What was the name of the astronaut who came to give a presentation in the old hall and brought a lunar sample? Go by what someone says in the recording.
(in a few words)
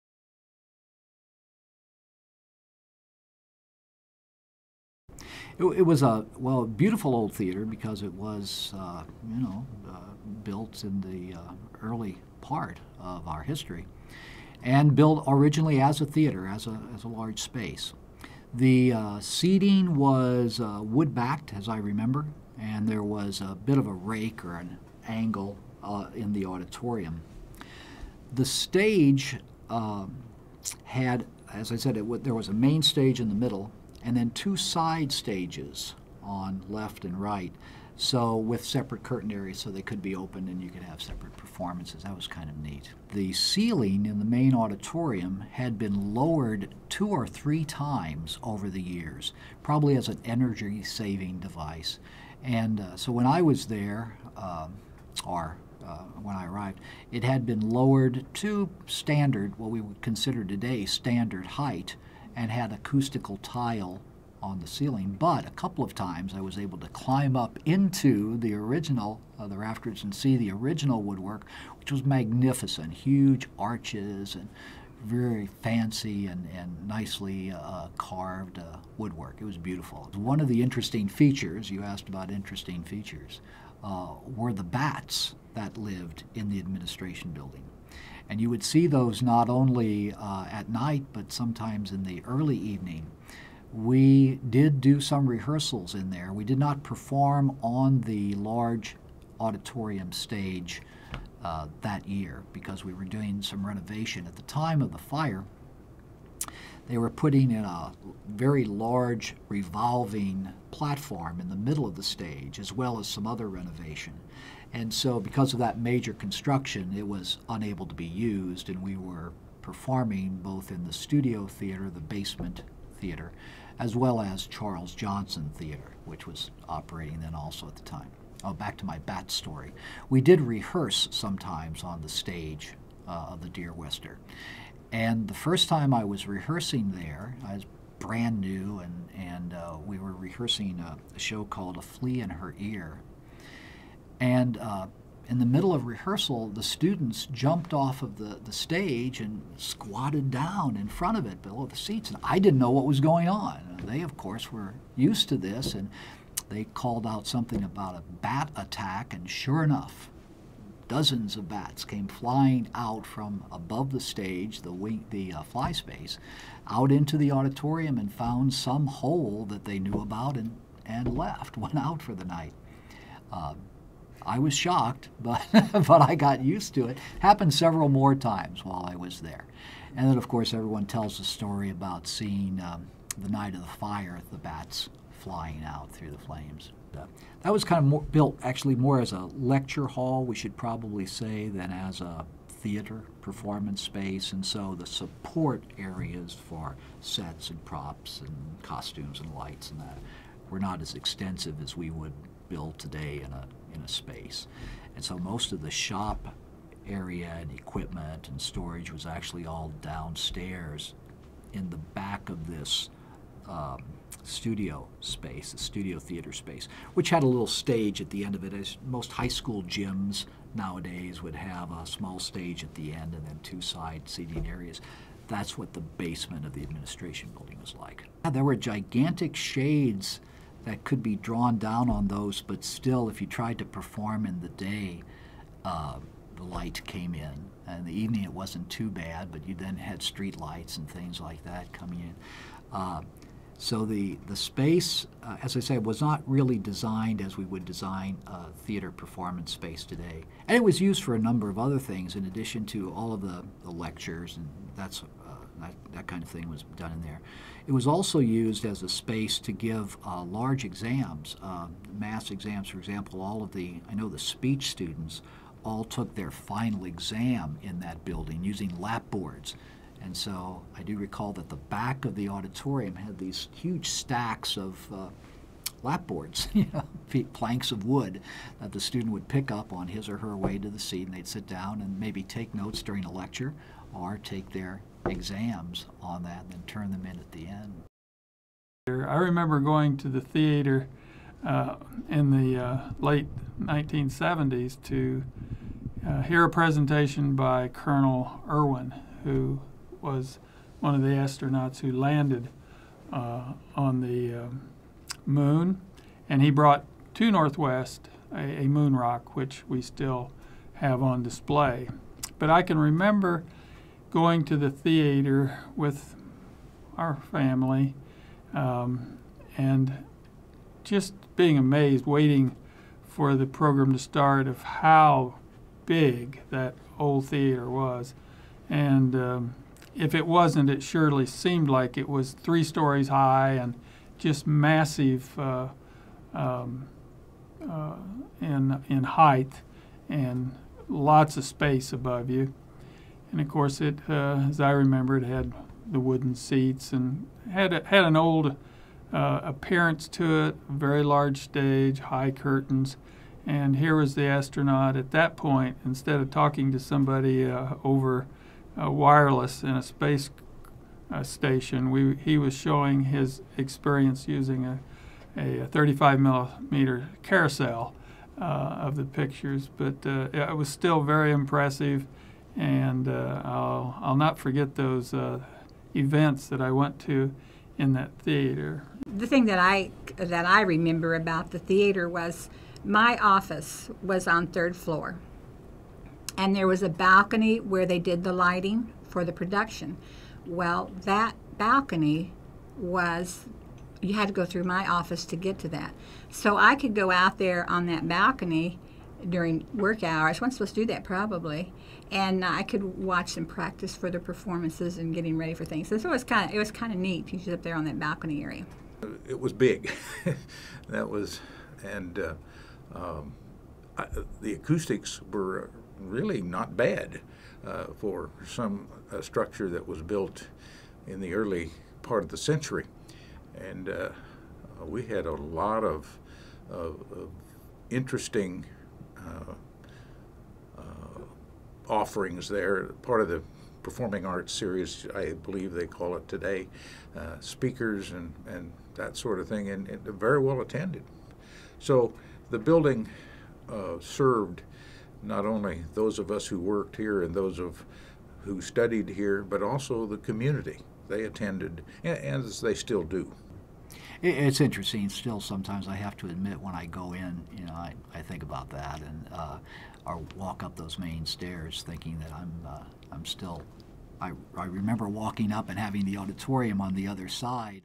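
Colonel Irwin.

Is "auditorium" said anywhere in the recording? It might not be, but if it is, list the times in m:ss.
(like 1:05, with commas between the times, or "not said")
0:26, 0:44, 1:39, 2:47, 4:32, 7:46.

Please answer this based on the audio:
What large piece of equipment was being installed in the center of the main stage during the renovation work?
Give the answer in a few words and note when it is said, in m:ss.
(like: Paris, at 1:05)
revolving platform, at 1:49.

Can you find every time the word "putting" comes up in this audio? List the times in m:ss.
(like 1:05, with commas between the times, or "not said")
1:47.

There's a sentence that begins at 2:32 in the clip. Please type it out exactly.
And I didn't know what was going on.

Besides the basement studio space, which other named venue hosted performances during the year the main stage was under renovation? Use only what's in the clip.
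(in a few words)
Charles Johnson Theater.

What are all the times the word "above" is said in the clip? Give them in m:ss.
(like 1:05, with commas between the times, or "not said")
2:43, 5:41.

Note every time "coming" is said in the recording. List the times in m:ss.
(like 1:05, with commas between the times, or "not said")
4:01.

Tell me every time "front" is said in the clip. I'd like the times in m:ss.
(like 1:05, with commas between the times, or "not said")
2:30.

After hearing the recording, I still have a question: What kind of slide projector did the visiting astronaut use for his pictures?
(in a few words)
35 millimeter carousel.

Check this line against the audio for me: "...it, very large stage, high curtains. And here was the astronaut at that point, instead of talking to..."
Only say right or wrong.
right.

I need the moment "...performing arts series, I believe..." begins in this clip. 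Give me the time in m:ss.
7:13.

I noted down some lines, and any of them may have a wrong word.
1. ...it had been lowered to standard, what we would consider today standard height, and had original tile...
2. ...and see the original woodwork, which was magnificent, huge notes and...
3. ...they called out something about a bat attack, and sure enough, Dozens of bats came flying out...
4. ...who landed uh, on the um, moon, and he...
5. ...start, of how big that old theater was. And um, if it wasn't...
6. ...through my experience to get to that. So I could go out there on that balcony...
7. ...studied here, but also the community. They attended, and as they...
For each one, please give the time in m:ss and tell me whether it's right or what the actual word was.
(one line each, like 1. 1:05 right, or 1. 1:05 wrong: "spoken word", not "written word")
1. 0:57 wrong: "acoustical", not "original"
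2. 1:10 wrong: "arches", not "notes"
3. 2:36 right
4. 5:01 right
5. 5:23 right
6. 6:34 wrong: "office", not "experience"
7. 7:28 right.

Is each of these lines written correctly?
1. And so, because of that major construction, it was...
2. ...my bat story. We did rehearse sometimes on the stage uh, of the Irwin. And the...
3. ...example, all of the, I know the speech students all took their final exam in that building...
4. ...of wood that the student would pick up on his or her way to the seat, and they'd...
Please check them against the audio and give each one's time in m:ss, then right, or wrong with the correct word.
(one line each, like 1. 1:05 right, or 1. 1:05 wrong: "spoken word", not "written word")
1. 1:54 right
2. 2:08 wrong: "Deerwester", not "Irwin"
3. 4:22 right
4. 4:37 right.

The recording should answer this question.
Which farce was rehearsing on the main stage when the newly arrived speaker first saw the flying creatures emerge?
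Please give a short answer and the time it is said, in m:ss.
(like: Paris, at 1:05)
A Flea in Her Ear, at 2:21.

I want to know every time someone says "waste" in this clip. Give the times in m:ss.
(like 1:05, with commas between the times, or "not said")
not said.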